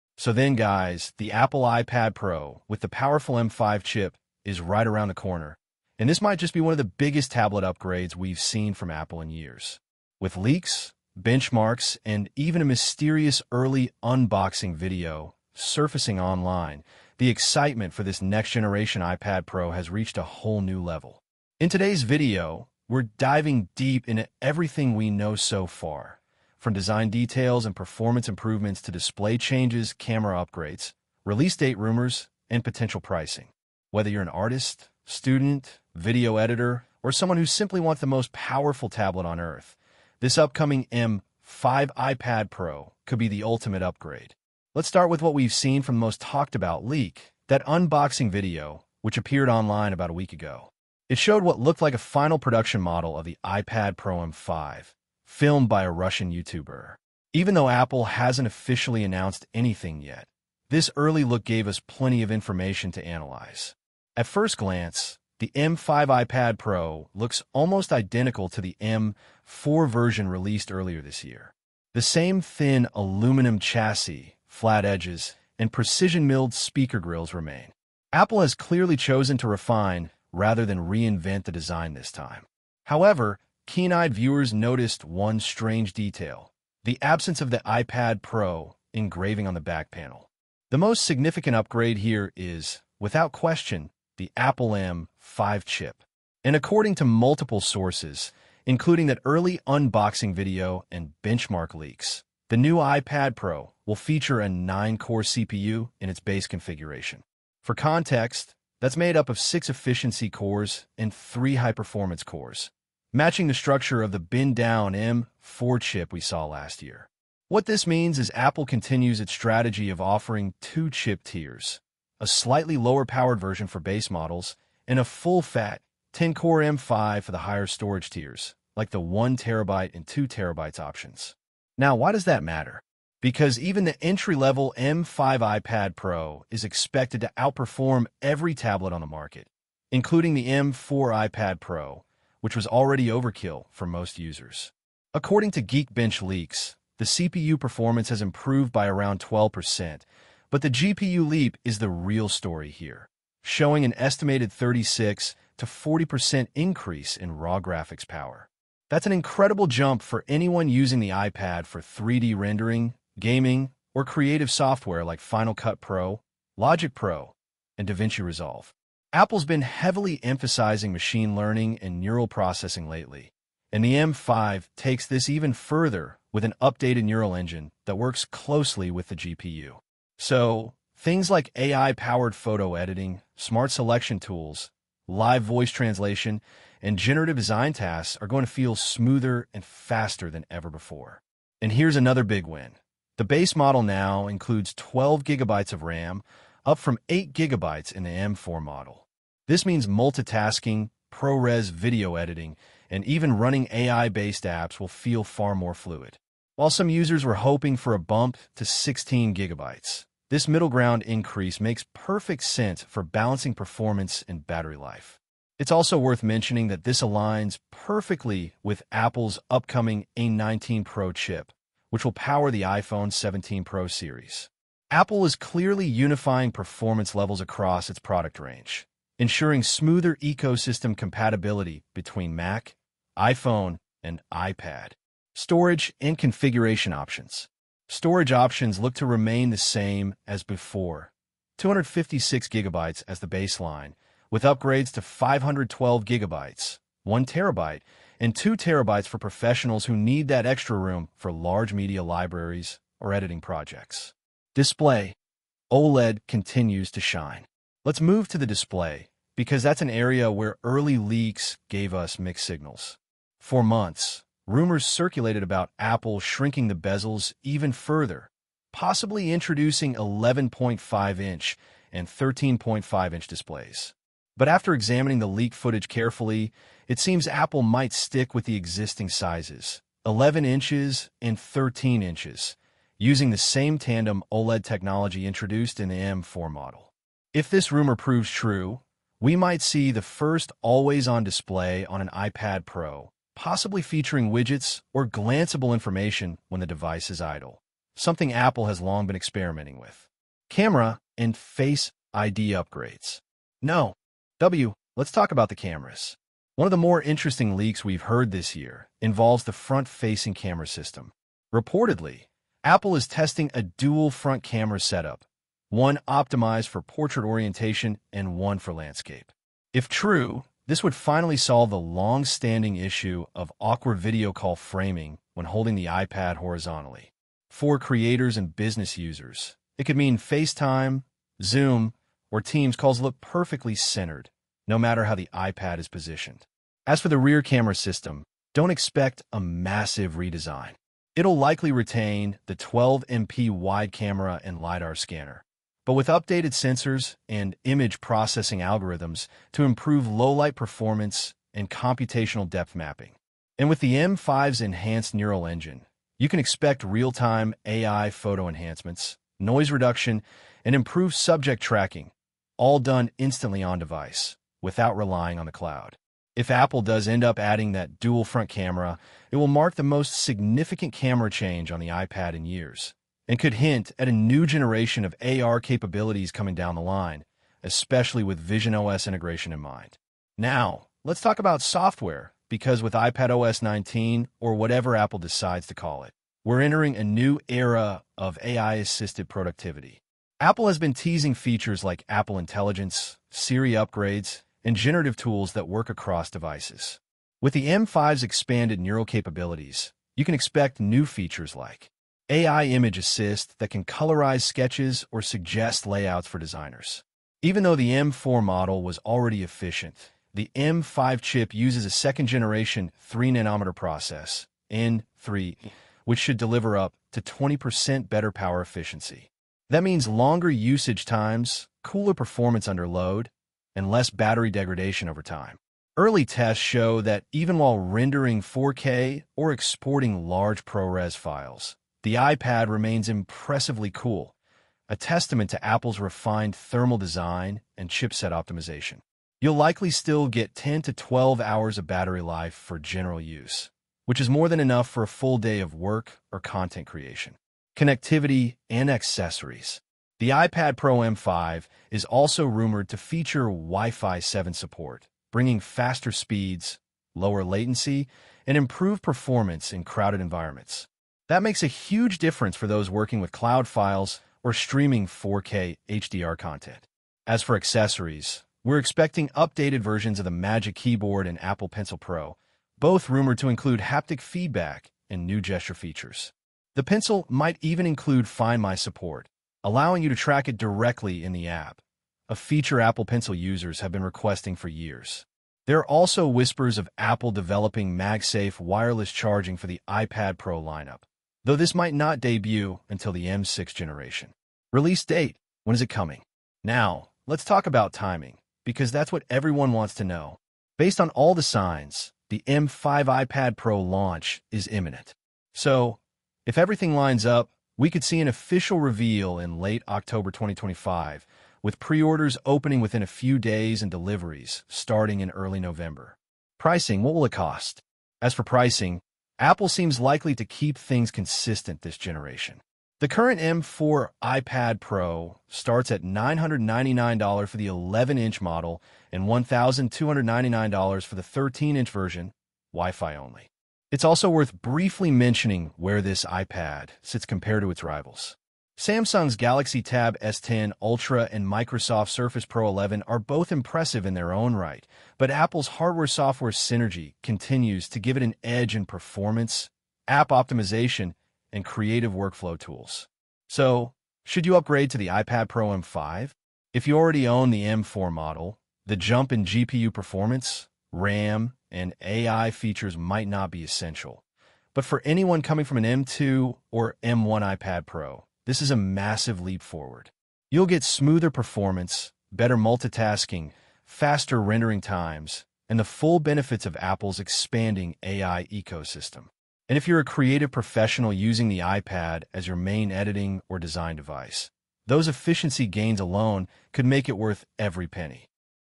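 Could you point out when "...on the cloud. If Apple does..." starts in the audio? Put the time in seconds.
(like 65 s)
365 s.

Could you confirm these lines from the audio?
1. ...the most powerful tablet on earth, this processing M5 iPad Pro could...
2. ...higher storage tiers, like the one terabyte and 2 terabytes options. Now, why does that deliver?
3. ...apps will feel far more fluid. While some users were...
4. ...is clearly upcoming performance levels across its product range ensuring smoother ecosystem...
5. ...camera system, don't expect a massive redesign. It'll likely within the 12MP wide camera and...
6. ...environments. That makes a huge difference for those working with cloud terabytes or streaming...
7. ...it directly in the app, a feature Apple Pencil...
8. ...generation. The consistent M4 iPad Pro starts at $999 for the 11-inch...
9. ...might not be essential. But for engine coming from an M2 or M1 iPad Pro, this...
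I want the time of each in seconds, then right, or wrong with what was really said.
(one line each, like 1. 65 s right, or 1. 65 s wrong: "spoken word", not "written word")
1. 37 s wrong: "upcoming", not "processing"
2. 127 s wrong: "matter", not "deliver"
3. 204 s right
4. 225 s wrong: "unifying", not "upcoming"
5. 337 s wrong: "retain", not "within"
6. 460 s wrong: "files", not "terabytes"
7. 480 s right
8. 521 s wrong: "current", not "consistent"
9. 562 s wrong: "anyone", not "engine".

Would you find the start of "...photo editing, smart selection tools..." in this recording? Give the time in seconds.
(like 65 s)
182 s.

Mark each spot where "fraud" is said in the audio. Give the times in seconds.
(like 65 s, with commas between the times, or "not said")
not said.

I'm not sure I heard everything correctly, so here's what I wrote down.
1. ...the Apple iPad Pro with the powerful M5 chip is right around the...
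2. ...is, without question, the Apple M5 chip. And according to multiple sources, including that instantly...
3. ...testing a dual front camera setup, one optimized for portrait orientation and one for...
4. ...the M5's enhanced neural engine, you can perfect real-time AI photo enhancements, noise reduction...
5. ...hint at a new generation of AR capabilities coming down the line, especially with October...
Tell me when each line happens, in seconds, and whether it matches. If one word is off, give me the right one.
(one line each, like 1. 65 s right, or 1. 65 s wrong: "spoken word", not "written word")
1. 1 s right
2. 92 s wrong: "early", not "instantly"
3. 313 s right
4. 353 s wrong: "expect", not "perfect"
5. 373 s wrong: "Vision", not "October".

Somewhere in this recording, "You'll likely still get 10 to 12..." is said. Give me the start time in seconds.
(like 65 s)
439 s.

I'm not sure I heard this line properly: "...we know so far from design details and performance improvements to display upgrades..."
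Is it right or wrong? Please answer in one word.
wrong.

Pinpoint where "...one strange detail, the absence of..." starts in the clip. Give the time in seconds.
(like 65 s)
85 s.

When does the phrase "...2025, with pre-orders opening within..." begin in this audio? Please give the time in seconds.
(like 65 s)
510 s.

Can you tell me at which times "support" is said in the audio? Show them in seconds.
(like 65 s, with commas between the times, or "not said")
454 s, 478 s.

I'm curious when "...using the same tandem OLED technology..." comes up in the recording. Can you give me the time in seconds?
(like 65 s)
282 s.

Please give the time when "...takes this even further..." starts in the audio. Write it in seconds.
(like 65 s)
174 s.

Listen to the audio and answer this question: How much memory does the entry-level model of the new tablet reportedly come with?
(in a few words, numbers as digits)
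12 gigabytes.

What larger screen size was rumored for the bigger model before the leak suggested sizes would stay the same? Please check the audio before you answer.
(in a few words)
13.5-inch.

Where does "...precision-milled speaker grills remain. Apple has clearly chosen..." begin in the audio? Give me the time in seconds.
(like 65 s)
75 s.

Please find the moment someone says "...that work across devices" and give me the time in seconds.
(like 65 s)
395 s.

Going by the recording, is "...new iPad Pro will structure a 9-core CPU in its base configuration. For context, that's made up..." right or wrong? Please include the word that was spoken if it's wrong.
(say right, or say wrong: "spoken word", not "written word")
wrong: "feature", not "structure".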